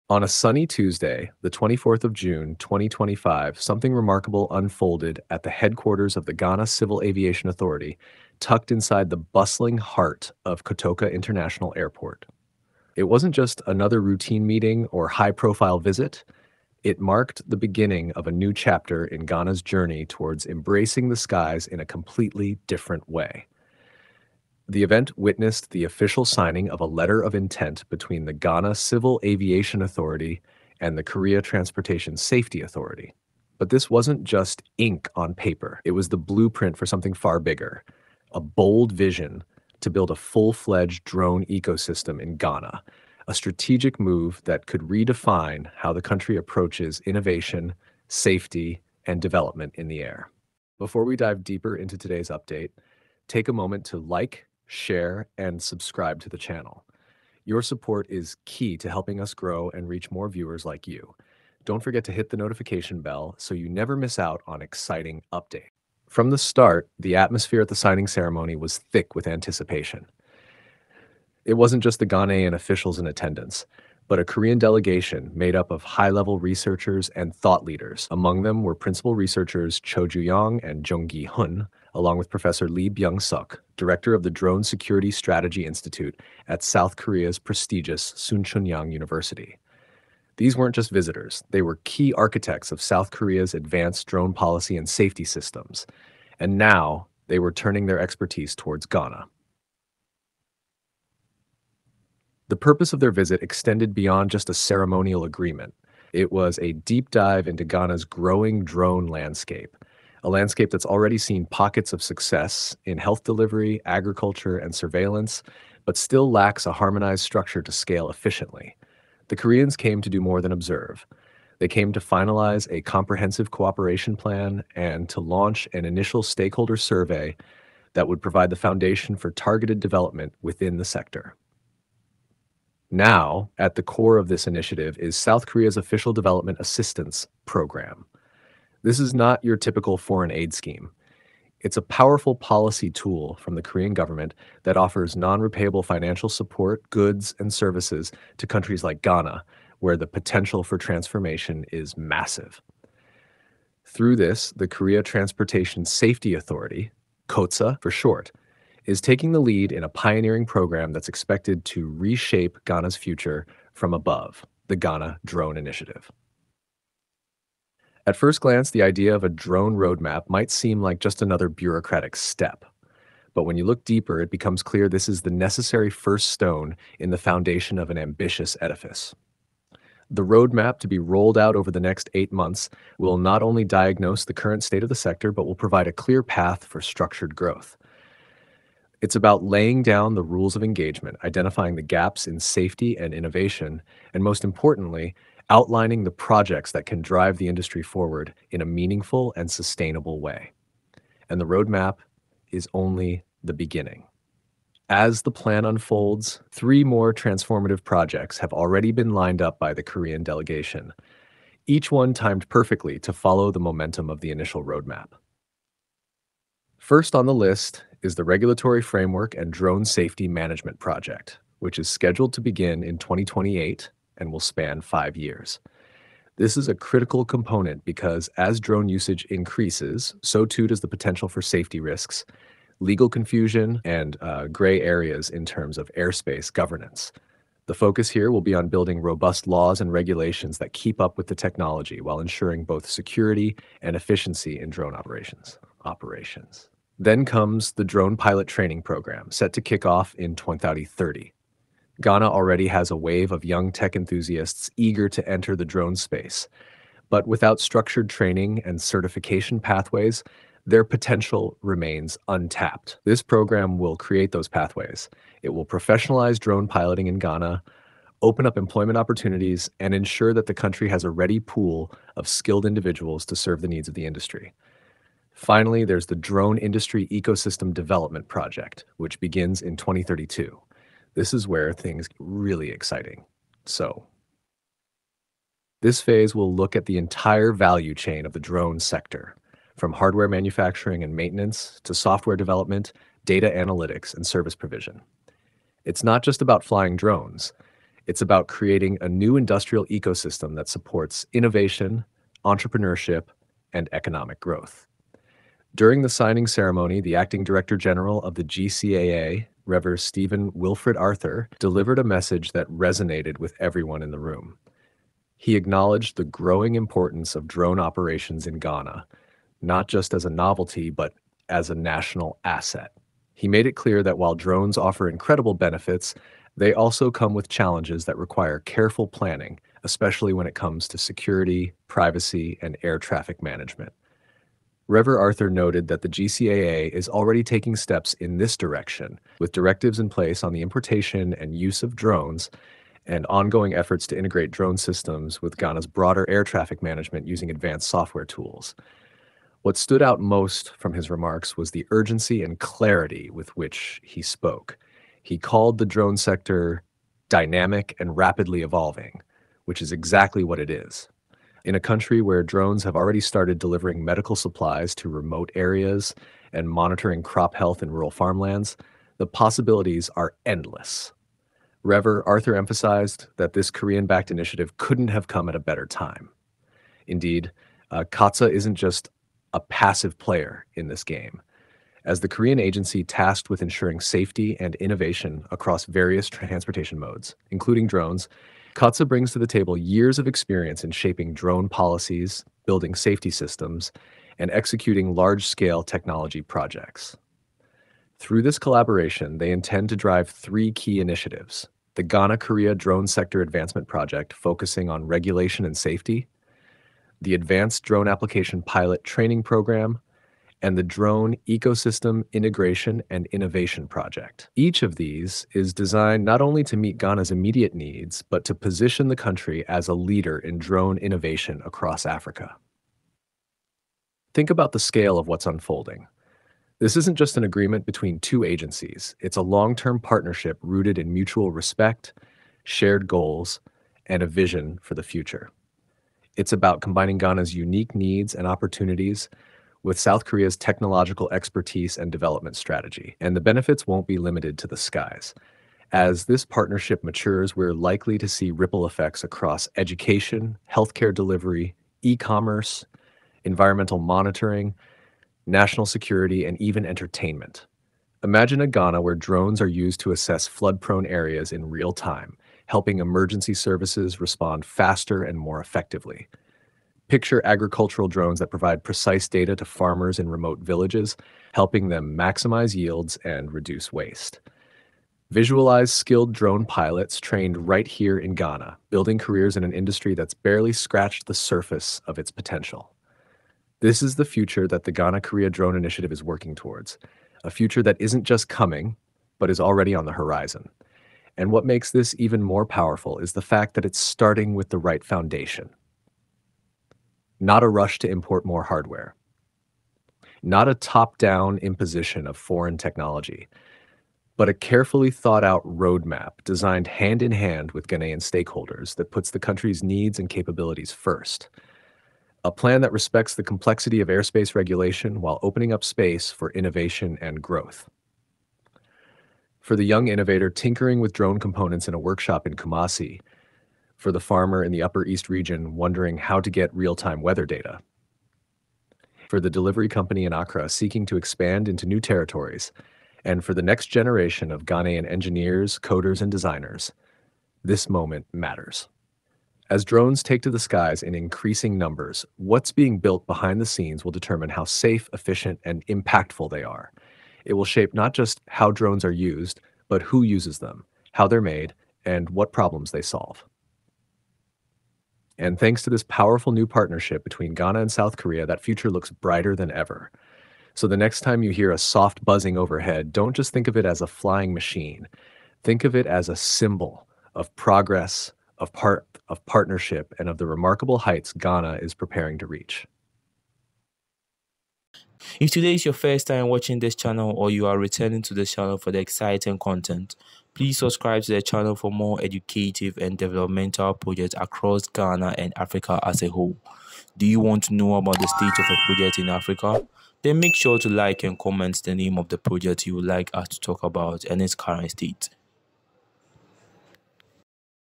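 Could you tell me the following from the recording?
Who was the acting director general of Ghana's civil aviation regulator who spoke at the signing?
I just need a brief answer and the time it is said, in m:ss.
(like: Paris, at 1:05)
Stephen Wilfred Arthur, at 5:09.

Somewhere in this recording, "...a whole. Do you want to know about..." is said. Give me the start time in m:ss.
9:46.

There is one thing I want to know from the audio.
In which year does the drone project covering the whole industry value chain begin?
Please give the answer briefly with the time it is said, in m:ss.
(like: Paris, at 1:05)
2032, at 4:39.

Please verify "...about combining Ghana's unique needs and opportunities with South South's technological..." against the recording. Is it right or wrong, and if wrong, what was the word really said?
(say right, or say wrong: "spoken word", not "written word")
wrong: "Korea", not "South".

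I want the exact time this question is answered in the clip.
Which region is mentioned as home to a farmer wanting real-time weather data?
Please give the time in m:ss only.
8:44.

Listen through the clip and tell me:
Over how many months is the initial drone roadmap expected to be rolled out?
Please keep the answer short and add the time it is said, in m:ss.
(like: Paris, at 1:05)
8, at 3:02.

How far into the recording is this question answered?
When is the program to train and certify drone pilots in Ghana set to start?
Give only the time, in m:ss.
4:10.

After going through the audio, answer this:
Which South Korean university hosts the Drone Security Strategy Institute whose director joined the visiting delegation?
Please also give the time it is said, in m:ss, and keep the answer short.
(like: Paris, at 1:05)
Chunyang University, at 1:28.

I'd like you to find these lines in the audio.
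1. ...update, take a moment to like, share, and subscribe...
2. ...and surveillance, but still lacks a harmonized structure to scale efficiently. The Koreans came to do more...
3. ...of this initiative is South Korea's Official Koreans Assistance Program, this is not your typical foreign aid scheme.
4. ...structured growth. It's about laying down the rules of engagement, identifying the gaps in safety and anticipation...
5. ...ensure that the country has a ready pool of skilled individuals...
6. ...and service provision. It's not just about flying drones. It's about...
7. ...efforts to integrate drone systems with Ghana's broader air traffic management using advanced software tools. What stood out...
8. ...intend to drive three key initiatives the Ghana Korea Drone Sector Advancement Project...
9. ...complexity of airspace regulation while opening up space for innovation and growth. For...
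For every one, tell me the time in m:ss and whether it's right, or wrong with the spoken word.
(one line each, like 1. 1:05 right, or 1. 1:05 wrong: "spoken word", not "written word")
1. 0:52 right
2. 1:54 right
3. 2:14 wrong: "Development", not "Koreans"
4. 3:06 wrong: "innovation", not "anticipation"
5. 4:29 right
6. 4:54 right
7. 5:43 right
8. 6:39 right
9. 8:33 right.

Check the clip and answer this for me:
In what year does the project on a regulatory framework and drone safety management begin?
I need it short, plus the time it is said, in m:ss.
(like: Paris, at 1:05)
2028, at 3:42.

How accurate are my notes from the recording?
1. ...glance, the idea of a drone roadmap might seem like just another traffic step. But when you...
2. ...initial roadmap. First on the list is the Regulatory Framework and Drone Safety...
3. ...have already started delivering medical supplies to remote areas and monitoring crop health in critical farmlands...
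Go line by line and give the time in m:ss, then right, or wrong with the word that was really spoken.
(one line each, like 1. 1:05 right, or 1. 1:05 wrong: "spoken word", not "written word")
1. 2:48 wrong: "bureaucratic", not "traffic"
2. 3:34 right
3. 6:02 wrong: "rural", not "critical".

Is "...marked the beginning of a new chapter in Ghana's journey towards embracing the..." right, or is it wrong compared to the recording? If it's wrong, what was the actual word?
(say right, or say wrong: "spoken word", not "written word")
right.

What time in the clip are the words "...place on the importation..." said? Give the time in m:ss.
5:40.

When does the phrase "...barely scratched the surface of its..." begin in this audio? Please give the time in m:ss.
8:00.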